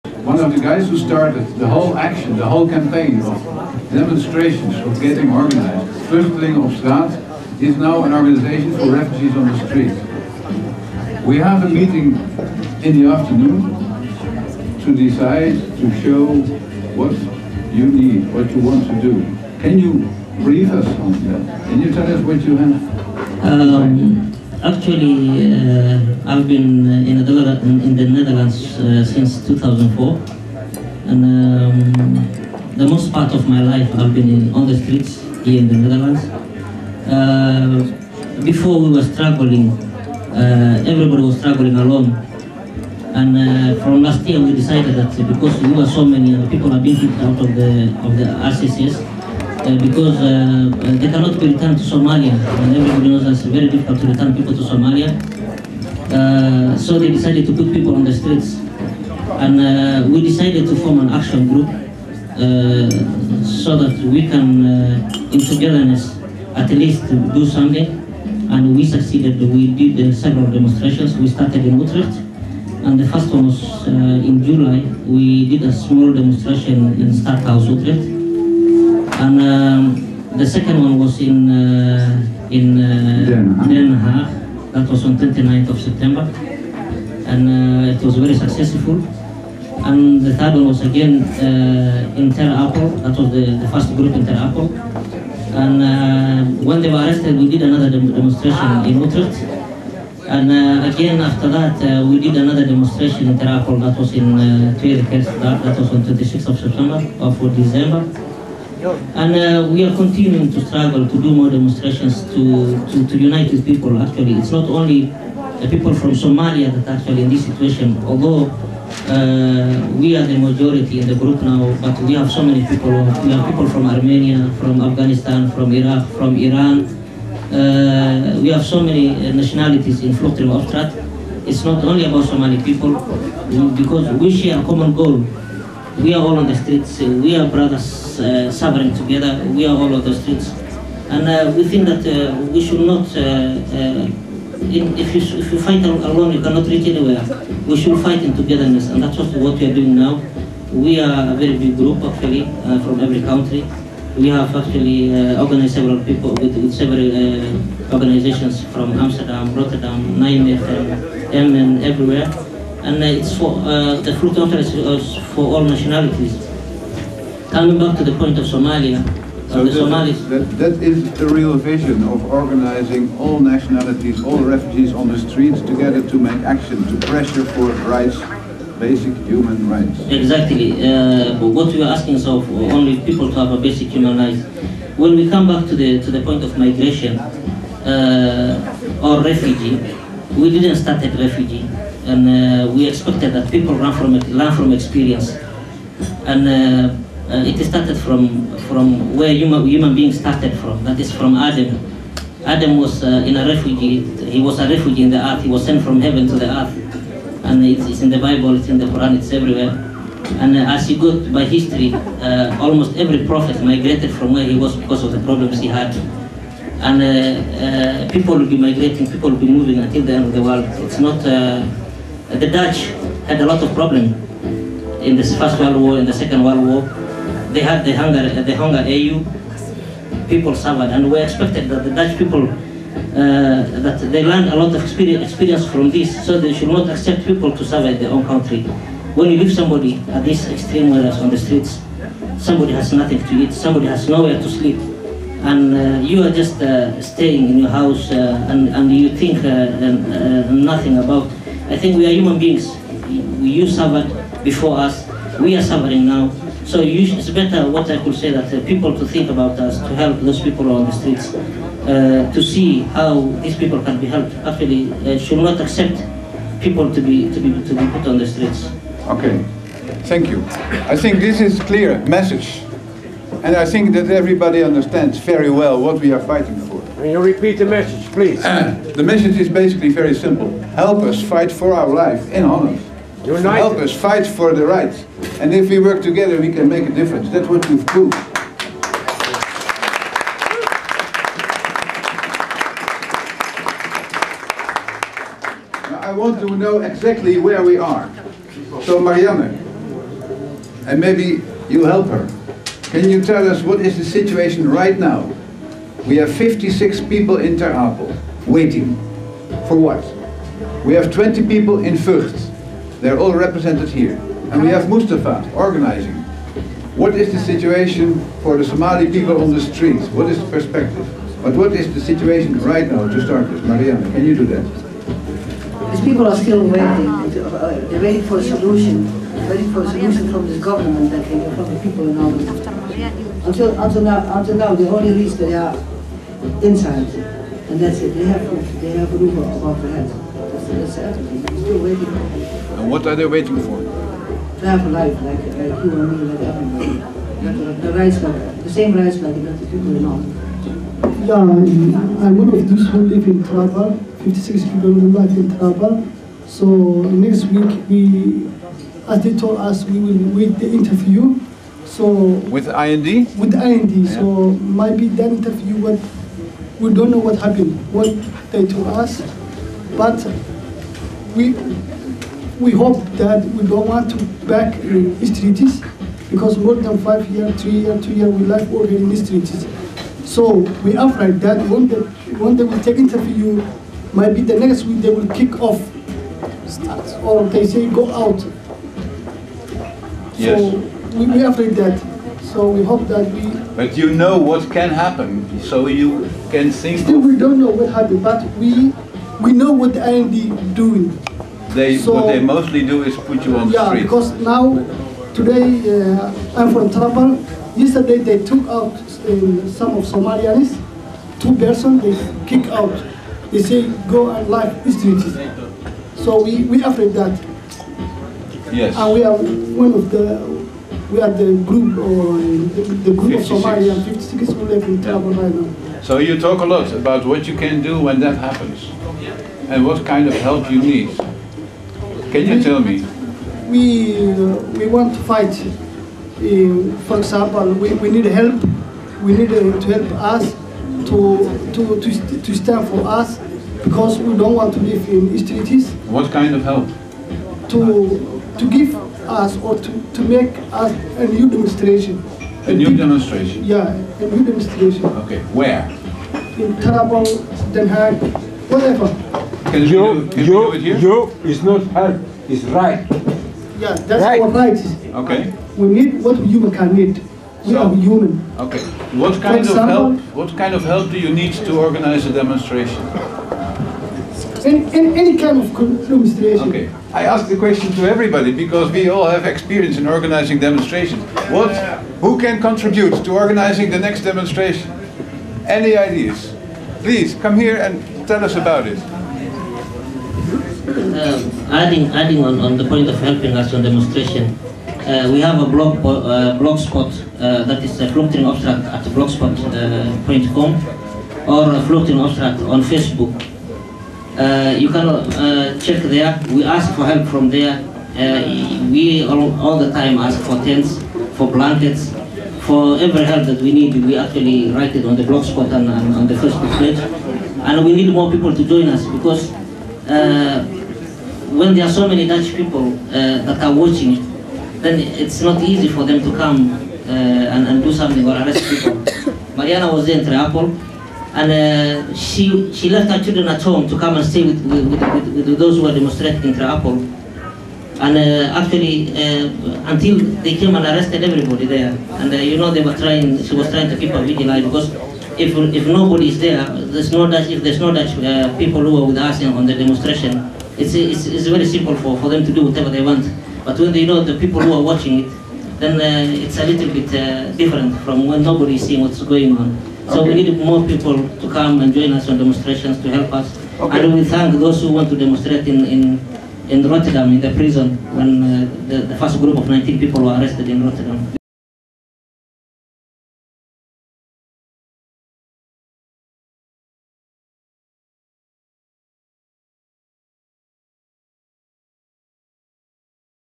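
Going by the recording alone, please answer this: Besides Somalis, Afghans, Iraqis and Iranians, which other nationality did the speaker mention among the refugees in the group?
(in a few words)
Armenia.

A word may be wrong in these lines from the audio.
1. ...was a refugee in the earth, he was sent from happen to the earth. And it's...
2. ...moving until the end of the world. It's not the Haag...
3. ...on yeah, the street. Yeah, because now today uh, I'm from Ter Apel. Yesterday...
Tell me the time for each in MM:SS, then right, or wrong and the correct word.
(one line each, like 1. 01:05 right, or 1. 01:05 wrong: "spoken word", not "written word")
1. 03:24 wrong: "heaven", not "happen"
2. 03:39 wrong: "Dutch", not "Haag"
3. 06:43 right.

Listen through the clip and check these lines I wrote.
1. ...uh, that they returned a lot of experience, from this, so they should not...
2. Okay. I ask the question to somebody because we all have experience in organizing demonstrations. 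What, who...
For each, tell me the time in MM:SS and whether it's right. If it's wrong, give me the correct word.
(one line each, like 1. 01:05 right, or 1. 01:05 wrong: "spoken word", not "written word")
1. 03:52 wrong: "learned", not "returned"
2. 07:56 wrong: "everybody", not "somebody".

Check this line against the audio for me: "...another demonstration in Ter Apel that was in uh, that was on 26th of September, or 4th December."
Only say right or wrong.
right.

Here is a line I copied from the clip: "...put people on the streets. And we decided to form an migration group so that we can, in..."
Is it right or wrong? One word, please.
wrong.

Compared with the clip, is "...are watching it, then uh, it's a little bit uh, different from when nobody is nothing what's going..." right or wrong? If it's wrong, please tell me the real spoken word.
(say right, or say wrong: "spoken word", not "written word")
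wrong: "seeing", not "nothing".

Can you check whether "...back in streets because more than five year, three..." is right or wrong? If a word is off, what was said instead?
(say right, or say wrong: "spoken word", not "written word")
right.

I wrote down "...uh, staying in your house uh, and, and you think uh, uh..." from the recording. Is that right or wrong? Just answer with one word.
right.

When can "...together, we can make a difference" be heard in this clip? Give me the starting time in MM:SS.
04:46.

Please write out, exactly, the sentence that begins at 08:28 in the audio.
Uh, we all, all the time ask for tents, for blankets, for every help that we need.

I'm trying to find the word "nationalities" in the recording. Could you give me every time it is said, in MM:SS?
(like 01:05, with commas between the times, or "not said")
02:09, 02:45, 02:53.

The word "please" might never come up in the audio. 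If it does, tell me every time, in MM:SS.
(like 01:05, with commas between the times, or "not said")
04:38, 08:06.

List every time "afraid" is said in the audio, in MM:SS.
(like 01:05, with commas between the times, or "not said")
06:20, 06:31, 06:56.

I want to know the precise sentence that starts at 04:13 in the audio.
You suffered before us, we are suffering now.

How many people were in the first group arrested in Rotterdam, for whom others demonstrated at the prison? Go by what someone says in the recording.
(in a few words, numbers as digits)
19.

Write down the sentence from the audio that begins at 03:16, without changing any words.
And uh, uh, it started from, from where human, human beings started from, that is from Adam.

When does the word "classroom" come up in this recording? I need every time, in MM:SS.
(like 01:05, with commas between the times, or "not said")
not said.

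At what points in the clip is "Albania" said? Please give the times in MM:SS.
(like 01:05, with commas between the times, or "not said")
05:32, 05:50.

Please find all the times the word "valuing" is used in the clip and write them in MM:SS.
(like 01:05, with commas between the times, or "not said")
not said.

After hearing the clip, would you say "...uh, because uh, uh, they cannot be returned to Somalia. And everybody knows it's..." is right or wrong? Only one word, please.
right.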